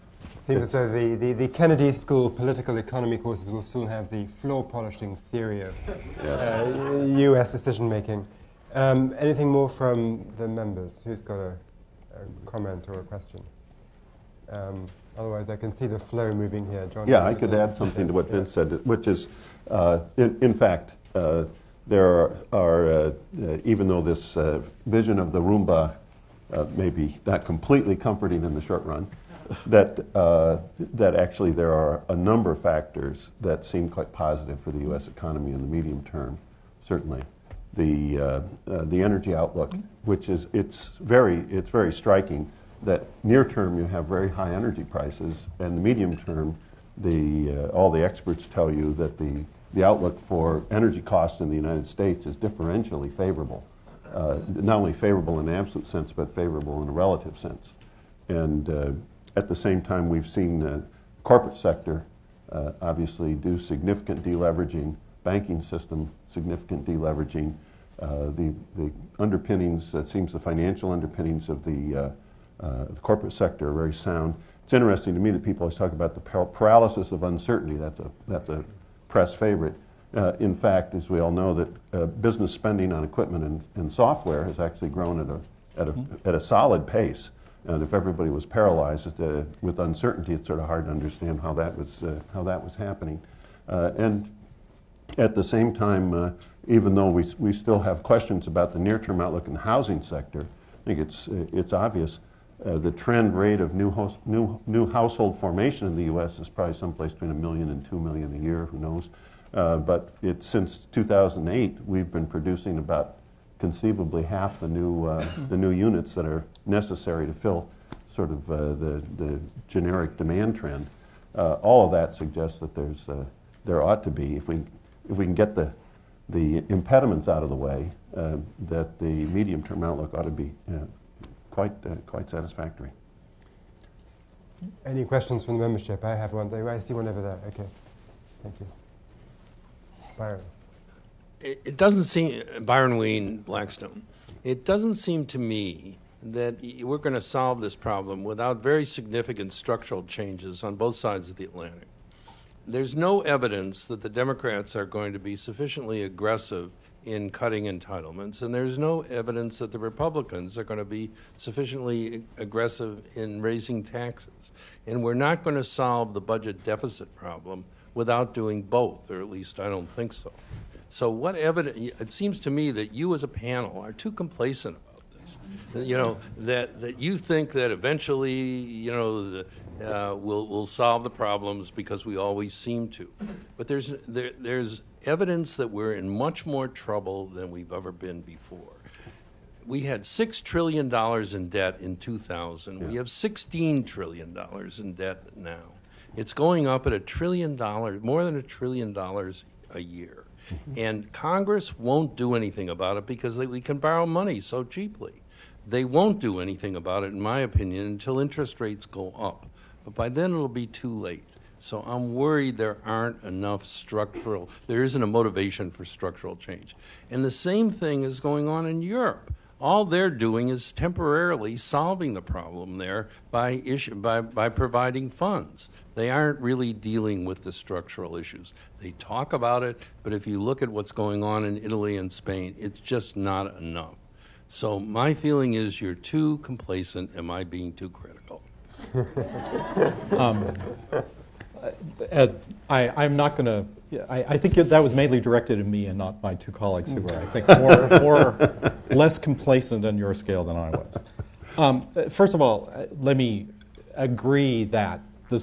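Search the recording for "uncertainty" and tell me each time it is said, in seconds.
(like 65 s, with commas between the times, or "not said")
77 s, 89 s.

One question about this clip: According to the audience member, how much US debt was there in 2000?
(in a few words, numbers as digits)
6 trillion dollars.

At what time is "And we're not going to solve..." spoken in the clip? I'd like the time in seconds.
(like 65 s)
164 s.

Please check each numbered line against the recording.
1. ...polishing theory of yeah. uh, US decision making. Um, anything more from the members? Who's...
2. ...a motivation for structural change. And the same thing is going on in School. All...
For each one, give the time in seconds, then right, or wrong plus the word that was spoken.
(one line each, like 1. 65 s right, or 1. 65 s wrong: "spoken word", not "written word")
1. 4 s right
2. 215 s wrong: "Europe", not "School".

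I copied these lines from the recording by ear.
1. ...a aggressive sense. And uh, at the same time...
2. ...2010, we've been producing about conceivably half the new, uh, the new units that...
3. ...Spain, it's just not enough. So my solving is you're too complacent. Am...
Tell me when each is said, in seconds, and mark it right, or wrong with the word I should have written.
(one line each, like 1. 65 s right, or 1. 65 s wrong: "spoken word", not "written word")
1. 56 s wrong: "relative", not "aggressive"
2. 110 s wrong: "2008", not "2010"
3. 232 s wrong: "feeling", not "solving".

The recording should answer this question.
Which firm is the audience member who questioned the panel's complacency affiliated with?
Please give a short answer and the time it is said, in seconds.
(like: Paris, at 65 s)
Blackstone, at 143 s.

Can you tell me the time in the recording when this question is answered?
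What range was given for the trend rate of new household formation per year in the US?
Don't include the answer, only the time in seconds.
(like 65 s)
107 s.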